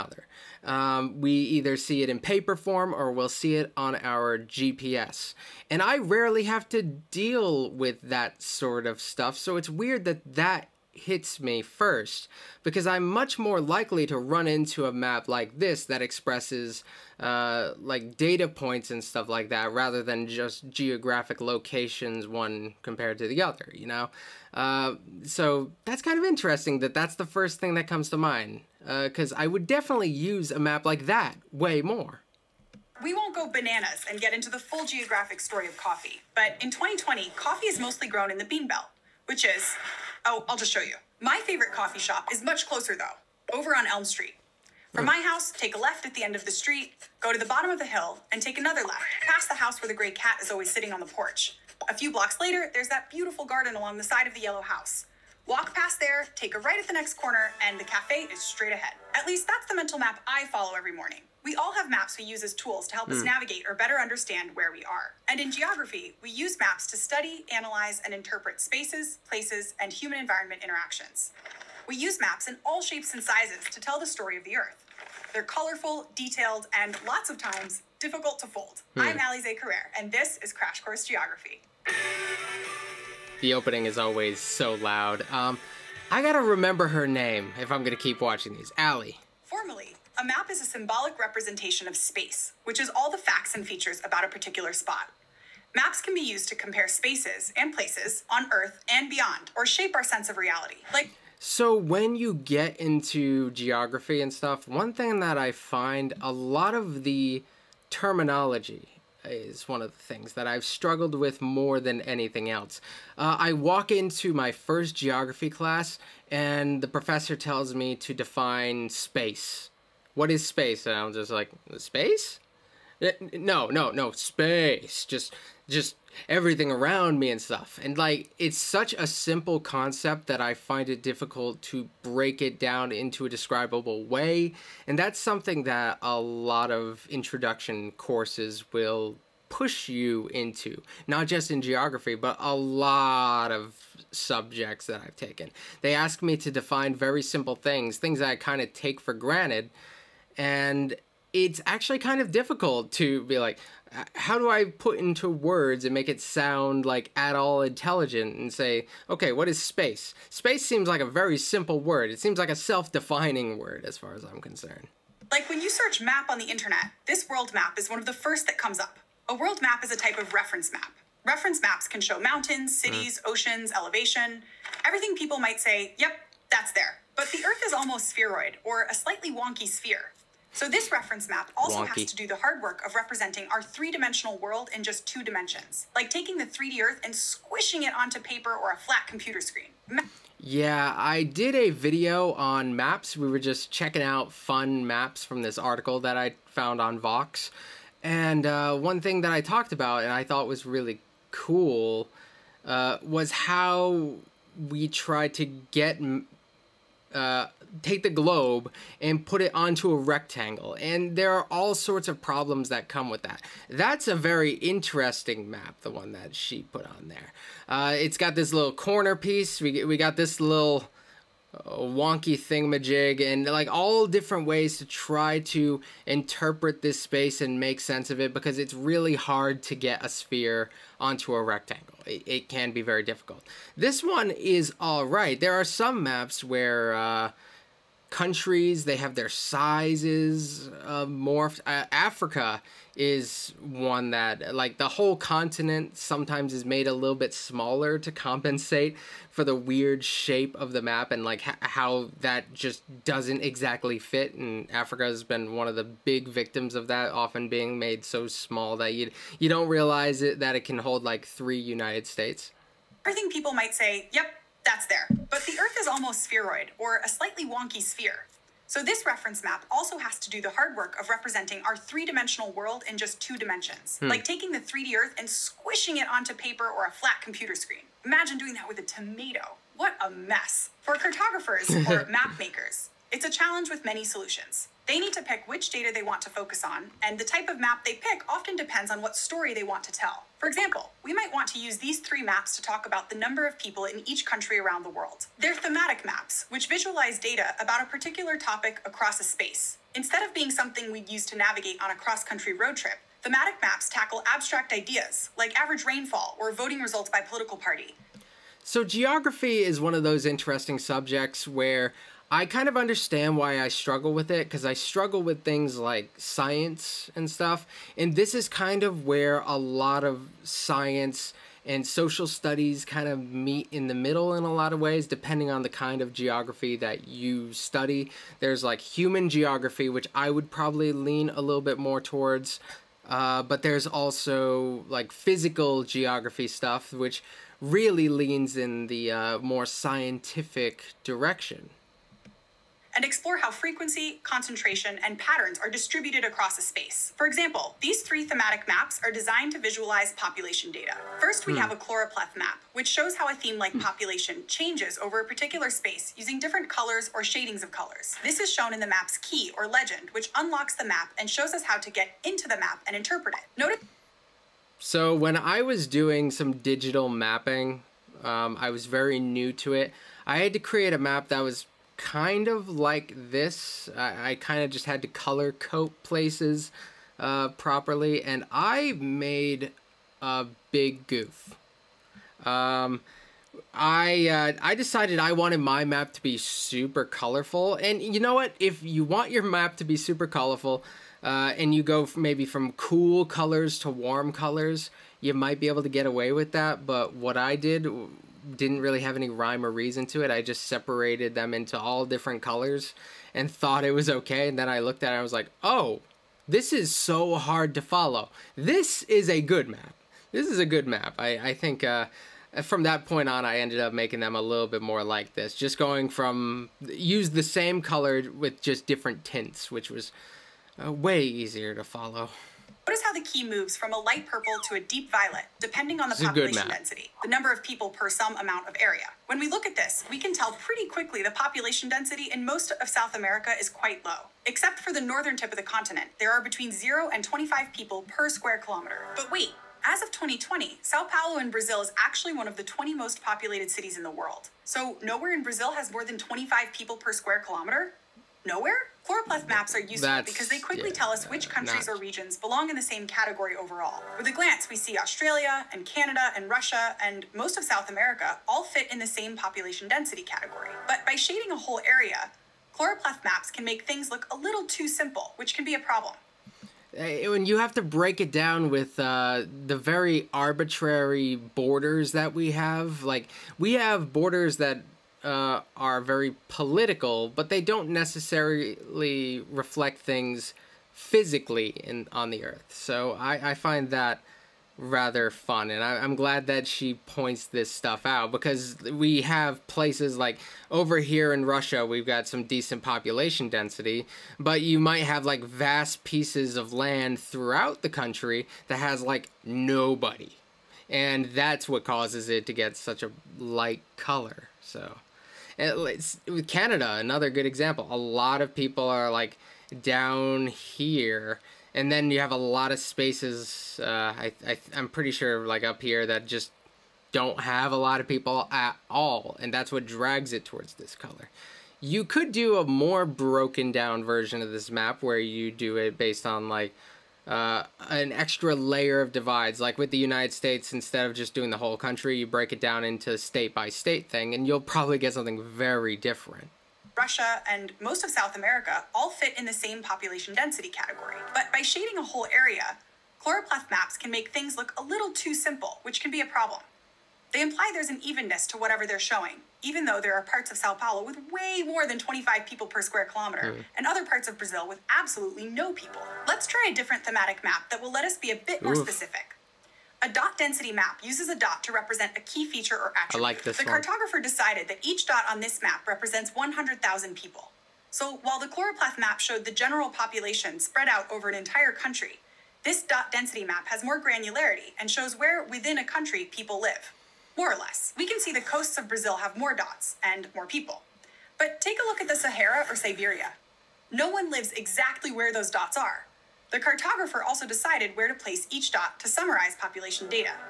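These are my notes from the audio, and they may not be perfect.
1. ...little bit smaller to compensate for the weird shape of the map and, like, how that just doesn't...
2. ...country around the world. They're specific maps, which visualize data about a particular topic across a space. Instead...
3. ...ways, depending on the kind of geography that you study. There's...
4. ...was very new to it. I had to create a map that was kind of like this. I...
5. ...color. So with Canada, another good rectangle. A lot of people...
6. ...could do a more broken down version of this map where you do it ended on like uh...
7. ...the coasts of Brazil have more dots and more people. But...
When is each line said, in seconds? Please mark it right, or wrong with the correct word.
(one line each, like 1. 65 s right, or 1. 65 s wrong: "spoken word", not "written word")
1. 246 s right
2. 294 s wrong: "thematic", not "specific"
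3. 324 s right
4. 368 s right
5. 503 s wrong: "example", not "rectangle"
6. 522 s wrong: "based", not "ended"
7. 578 s right.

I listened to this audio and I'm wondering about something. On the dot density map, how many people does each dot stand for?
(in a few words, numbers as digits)
100,000.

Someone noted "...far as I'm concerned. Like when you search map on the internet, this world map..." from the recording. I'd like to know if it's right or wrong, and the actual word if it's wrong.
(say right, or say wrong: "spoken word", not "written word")
right.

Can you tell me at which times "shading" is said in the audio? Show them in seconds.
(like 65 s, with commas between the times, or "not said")
357 s, 461 s, 541 s.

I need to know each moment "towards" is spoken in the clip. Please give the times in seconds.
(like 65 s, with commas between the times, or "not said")
332 s, 520 s.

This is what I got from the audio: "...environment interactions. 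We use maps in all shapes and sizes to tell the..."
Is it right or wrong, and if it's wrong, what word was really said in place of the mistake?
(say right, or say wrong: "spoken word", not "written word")
right.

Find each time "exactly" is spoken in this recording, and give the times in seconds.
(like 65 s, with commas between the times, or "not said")
253 s, 584 s.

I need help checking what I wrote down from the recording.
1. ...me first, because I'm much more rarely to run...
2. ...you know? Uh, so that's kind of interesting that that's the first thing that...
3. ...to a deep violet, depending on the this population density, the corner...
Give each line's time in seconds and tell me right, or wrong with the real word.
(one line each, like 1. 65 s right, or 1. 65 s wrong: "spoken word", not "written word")
1. 11 s wrong: "likely", not "rarely"
2. 23 s right
3. 424 s wrong: "number", not "corner".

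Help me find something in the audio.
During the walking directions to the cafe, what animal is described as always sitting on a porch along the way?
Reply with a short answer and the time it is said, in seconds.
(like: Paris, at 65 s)
gray cat, at 49 s.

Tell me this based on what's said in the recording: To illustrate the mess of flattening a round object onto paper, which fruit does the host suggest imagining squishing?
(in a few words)
tomato.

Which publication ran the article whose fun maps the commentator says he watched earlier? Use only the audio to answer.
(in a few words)
Vox.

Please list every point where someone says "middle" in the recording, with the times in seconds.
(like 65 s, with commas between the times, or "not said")
323 s.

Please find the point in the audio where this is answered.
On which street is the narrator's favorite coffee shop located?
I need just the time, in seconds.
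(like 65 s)
43 s.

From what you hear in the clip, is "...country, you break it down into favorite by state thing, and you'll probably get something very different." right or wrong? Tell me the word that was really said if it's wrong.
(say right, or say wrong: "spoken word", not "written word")
wrong: "state", not "favorite".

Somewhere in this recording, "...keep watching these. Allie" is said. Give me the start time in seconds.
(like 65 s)
87 s.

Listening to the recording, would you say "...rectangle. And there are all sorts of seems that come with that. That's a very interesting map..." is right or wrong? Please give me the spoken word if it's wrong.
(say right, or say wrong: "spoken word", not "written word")
wrong: "problems", not "seems".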